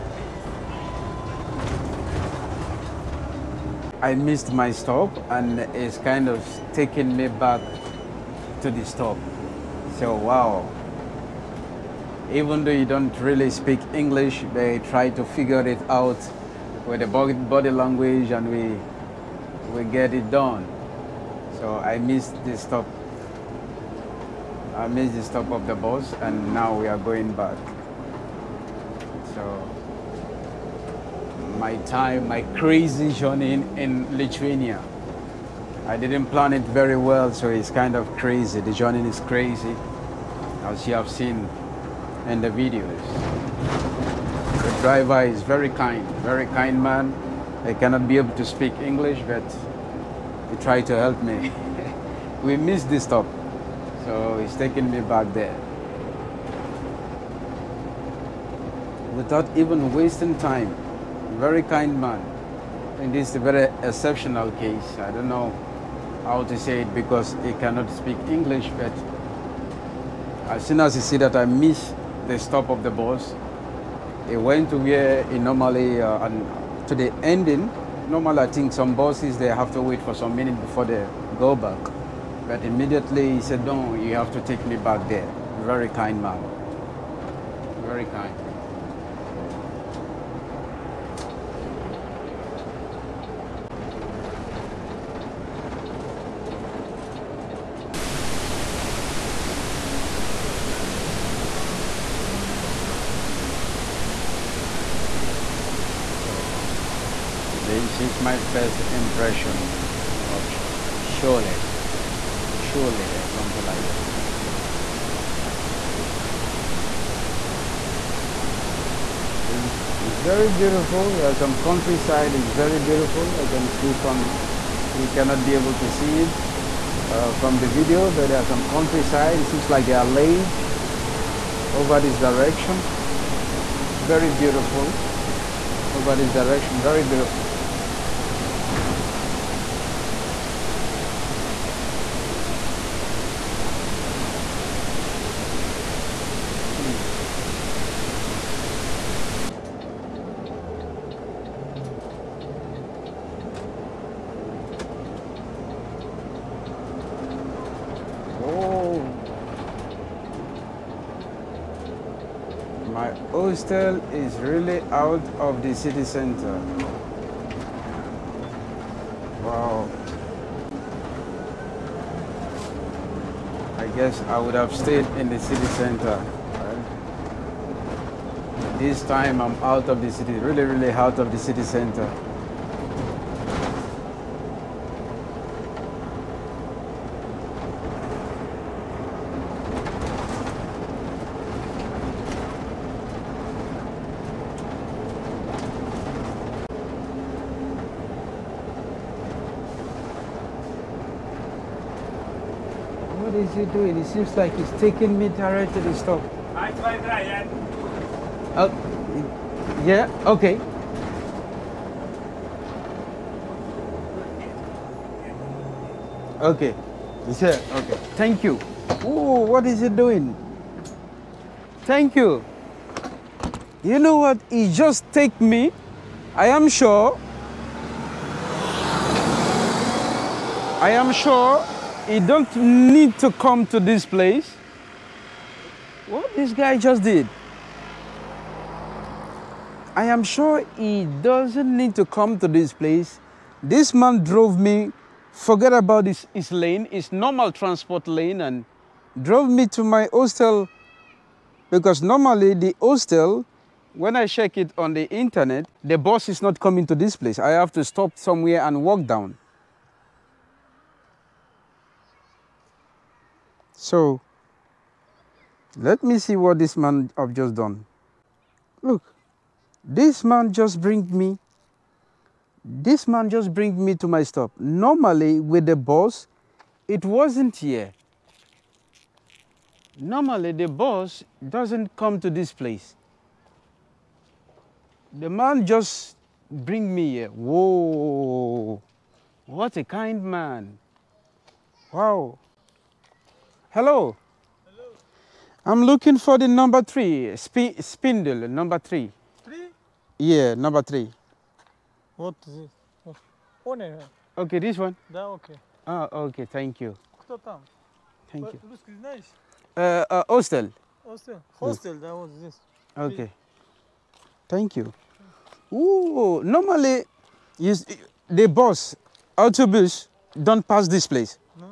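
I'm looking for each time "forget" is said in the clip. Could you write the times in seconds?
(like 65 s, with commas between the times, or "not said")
245 s.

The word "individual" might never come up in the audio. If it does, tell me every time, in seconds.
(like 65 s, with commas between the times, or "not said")
not said.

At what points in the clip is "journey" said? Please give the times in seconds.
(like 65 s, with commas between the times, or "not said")
33 s, 38 s.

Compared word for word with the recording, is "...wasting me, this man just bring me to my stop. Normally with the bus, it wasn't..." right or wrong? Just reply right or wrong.
wrong.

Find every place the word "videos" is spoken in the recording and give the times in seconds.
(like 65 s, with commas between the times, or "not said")
42 s, 127 s.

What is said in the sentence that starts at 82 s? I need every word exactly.
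But immediately he said, no, you have to take me back there.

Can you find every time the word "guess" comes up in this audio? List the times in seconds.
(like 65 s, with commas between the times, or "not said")
173 s.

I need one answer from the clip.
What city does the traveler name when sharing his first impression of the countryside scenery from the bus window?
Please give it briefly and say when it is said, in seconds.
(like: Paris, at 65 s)
Šiauliai, at 111 s.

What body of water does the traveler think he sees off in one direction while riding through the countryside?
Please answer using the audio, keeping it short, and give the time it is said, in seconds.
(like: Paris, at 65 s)
lake, at 130 s.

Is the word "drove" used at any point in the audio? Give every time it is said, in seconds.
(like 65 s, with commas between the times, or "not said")
244 s, 249 s.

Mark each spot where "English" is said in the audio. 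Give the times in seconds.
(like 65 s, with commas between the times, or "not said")
13 s, 48 s, 68 s.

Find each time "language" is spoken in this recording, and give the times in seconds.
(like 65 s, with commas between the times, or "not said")
17 s.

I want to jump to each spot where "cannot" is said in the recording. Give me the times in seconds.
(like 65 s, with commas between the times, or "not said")
47 s, 67 s, 125 s.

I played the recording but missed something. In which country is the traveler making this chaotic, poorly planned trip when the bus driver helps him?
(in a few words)
Lithuania.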